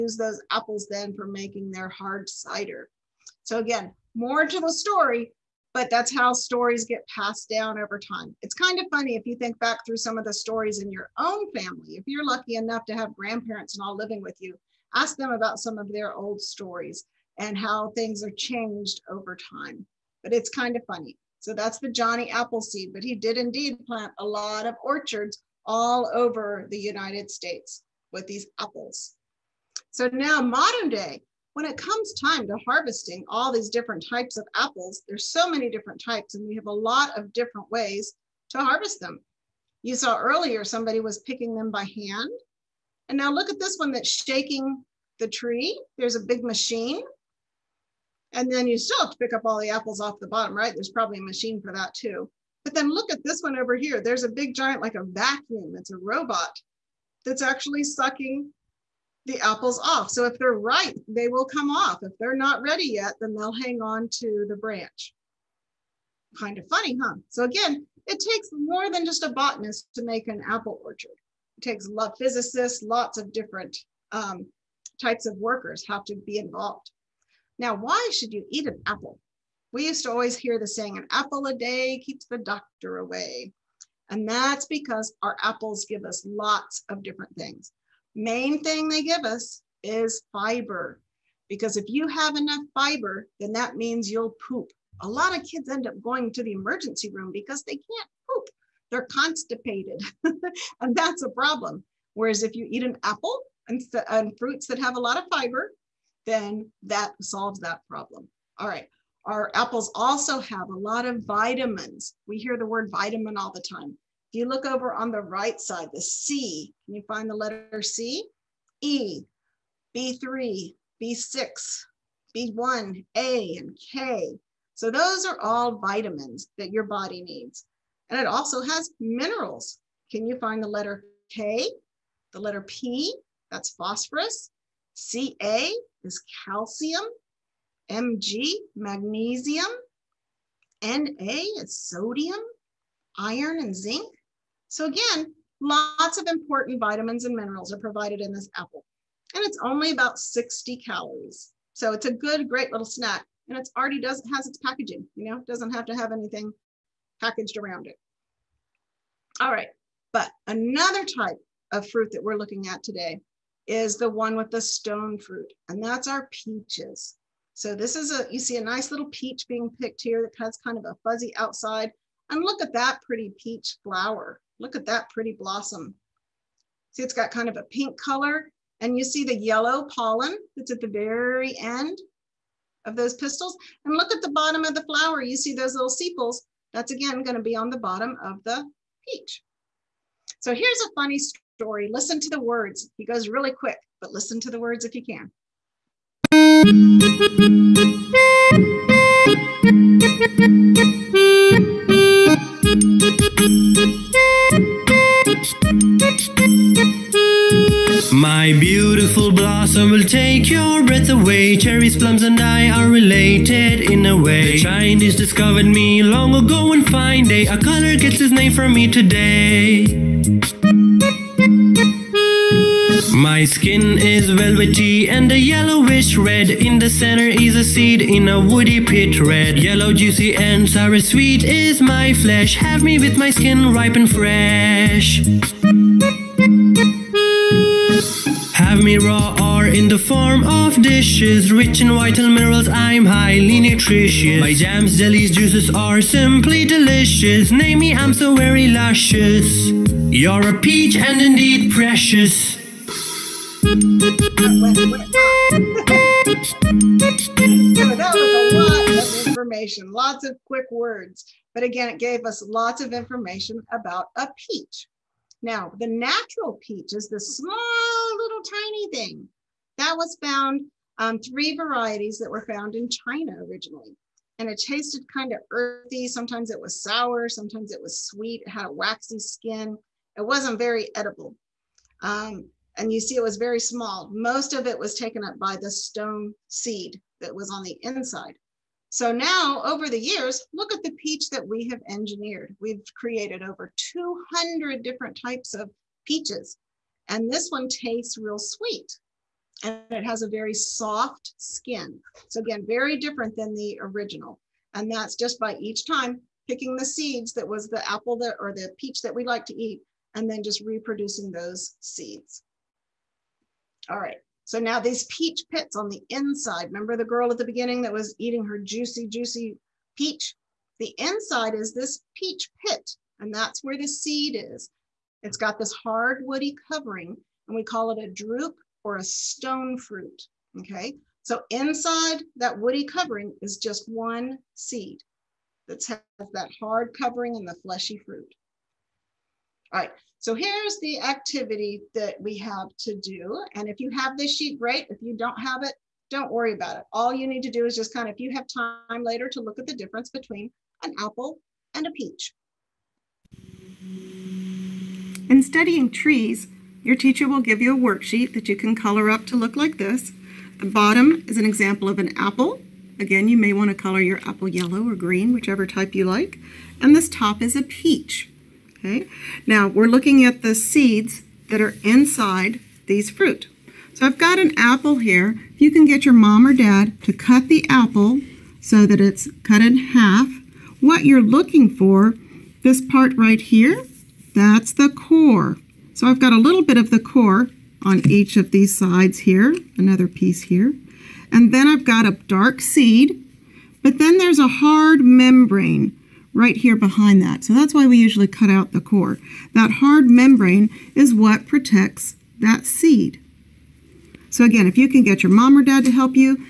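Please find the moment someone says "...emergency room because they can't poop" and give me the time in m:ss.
1:36.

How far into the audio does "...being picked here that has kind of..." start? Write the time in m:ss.
2:49.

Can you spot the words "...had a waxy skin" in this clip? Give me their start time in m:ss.
4:38.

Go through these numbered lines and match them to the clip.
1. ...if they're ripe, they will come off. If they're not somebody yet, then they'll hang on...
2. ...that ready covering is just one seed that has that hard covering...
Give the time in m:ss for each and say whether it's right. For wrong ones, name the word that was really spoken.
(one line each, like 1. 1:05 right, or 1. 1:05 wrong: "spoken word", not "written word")
1. 1:00 wrong: "ready", not "somebody"
2. 5:32 wrong: "woody", not "ready".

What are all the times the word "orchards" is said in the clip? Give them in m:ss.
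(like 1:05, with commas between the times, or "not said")
0:24, 1:10.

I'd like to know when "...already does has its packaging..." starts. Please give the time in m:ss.
2:33.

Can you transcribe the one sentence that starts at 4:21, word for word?
But again, it gave us lots of information about a peach.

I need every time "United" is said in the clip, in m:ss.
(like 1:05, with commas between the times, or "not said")
0:26.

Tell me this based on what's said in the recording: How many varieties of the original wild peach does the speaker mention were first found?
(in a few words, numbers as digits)
3.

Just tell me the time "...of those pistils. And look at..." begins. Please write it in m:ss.
3:02.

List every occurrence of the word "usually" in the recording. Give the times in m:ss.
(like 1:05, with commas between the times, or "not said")
6:37.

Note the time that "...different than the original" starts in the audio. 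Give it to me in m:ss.
5:02.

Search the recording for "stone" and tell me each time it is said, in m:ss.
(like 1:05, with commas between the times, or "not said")
2:44, 4:45, 5:29.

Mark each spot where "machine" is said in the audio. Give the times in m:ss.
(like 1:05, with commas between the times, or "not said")
0:46, 0:51.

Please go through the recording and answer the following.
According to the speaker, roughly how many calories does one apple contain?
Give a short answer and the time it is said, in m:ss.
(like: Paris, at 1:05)
60, at 2:30.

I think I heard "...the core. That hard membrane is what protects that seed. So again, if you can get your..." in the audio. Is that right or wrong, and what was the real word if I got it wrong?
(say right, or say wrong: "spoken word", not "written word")
right.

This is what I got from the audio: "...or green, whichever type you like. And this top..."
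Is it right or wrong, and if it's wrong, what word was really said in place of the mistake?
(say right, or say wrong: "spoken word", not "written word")
right.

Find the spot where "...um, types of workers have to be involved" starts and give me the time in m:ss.
1:14.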